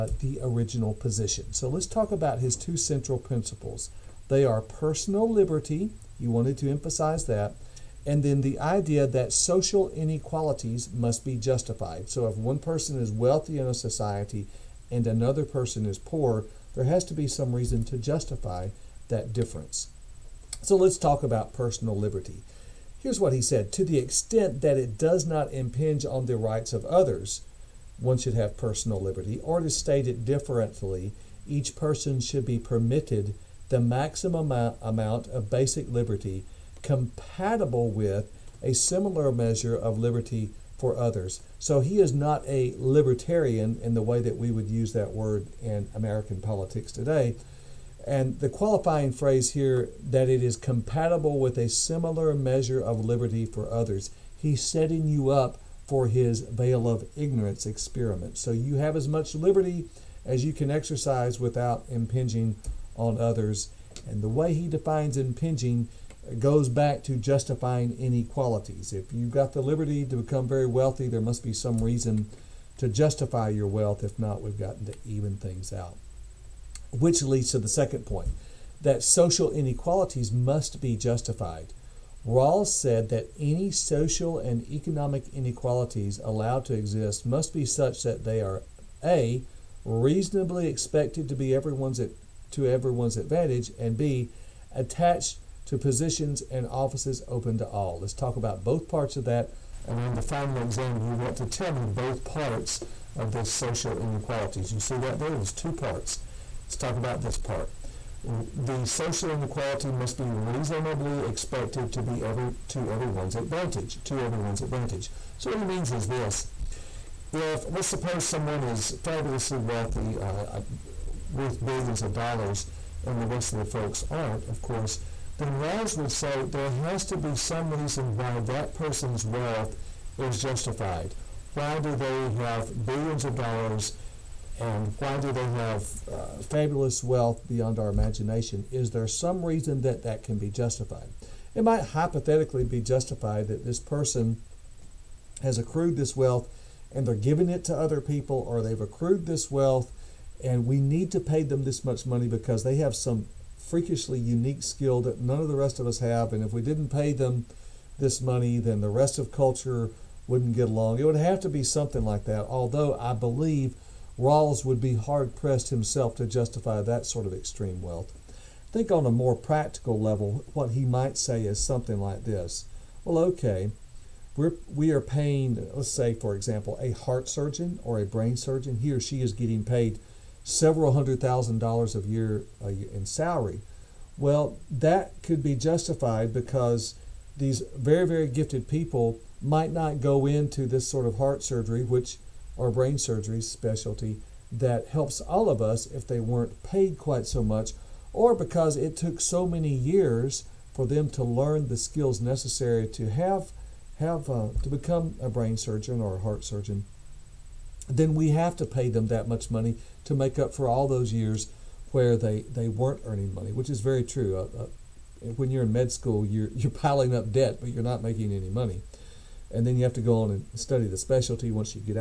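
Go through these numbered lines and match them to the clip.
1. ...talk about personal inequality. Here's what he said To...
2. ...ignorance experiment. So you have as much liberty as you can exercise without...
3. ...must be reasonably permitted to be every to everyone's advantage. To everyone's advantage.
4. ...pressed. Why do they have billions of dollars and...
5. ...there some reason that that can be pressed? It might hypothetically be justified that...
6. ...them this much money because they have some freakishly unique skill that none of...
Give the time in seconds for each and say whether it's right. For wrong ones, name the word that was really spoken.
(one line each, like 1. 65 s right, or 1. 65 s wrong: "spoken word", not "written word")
1. 20 s wrong: "liberty", not "inequality"
2. 57 s right
3. 109 s wrong: "expected", not "permitted"
4. 130 s wrong: "justified", not "pressed"
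5. 138 s wrong: "justified", not "pressed"
6. 151 s right.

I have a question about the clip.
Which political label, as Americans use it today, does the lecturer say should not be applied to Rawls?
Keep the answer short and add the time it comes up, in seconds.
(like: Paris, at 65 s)
libertarian, at 42 s.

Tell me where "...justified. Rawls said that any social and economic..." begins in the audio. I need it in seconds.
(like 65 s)
80 s.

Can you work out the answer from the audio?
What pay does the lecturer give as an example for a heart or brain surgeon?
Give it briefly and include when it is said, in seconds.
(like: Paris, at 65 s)
several hundred thousand dollars, at 180 s.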